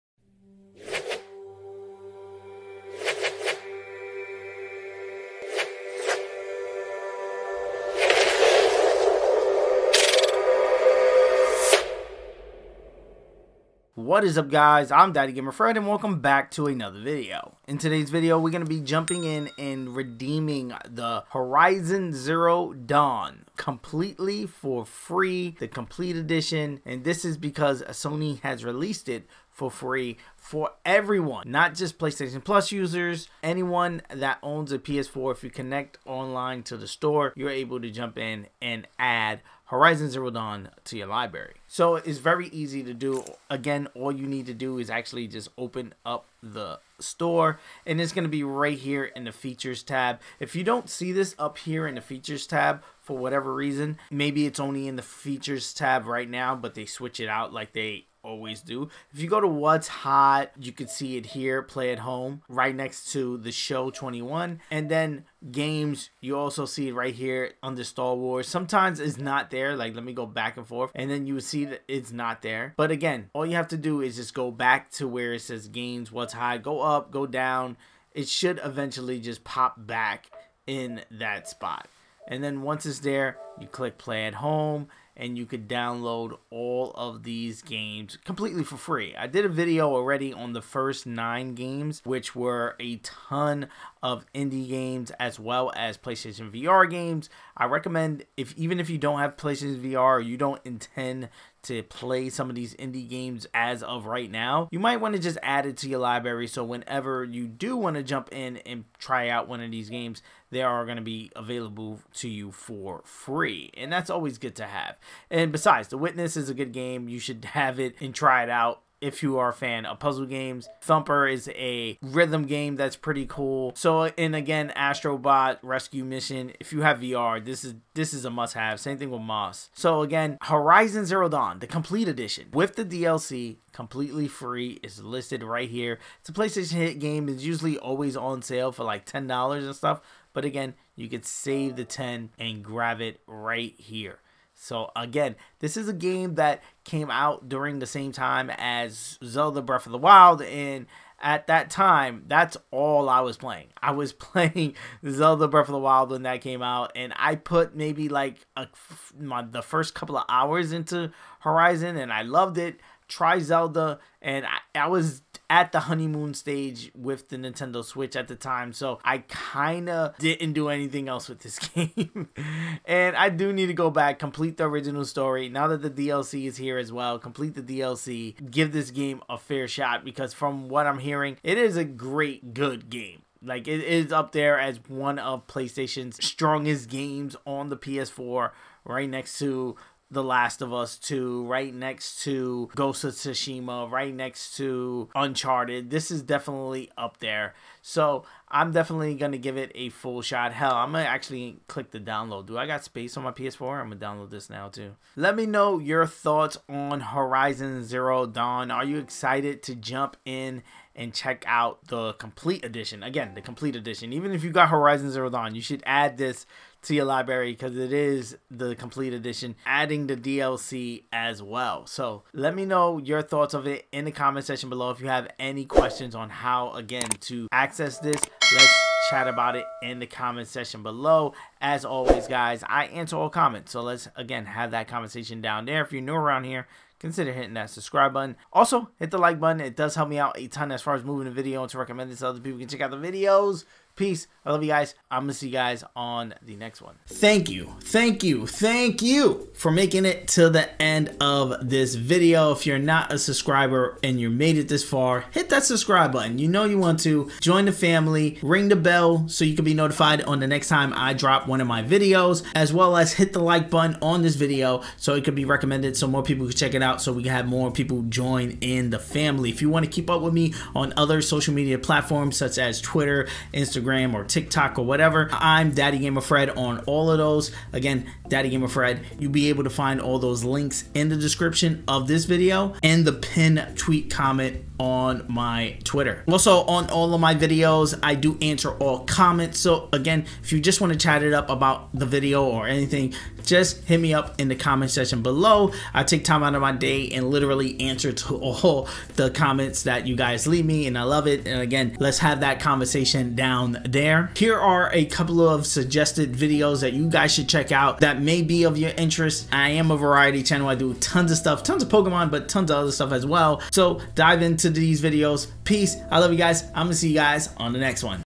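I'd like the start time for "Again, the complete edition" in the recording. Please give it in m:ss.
3:33.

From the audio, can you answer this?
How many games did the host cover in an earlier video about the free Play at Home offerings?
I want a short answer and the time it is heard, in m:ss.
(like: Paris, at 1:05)
9, at 1:31.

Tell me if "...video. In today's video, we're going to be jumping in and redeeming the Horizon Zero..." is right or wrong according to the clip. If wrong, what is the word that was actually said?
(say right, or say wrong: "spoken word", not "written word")
right.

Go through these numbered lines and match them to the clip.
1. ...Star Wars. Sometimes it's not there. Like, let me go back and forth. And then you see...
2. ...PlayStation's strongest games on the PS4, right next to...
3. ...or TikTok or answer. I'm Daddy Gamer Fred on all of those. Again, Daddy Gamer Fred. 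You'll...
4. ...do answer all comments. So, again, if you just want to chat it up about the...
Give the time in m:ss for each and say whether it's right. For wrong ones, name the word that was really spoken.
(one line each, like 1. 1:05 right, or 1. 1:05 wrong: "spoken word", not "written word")
1. 1:07 right
2. 3:05 right
3. 4:34 wrong: "whatever", not "answer"
4. 4:48 right.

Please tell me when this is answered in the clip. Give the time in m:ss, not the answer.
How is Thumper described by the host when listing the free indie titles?
2:02.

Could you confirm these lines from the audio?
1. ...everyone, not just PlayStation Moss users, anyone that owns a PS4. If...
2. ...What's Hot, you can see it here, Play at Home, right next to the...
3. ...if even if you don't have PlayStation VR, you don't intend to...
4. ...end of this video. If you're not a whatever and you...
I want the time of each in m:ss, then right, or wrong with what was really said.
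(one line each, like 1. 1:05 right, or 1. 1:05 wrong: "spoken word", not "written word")
1. 0:30 wrong: "Plus", not "Moss"
2. 0:59 right
3. 1:38 right
4. 4:10 wrong: "subscriber", not "whatever".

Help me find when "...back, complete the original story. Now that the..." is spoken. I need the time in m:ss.
2:53.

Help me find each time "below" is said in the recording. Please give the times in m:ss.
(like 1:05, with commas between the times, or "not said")
3:44, 3:50, 4:55.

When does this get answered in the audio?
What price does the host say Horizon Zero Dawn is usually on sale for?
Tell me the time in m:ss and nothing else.
2:19.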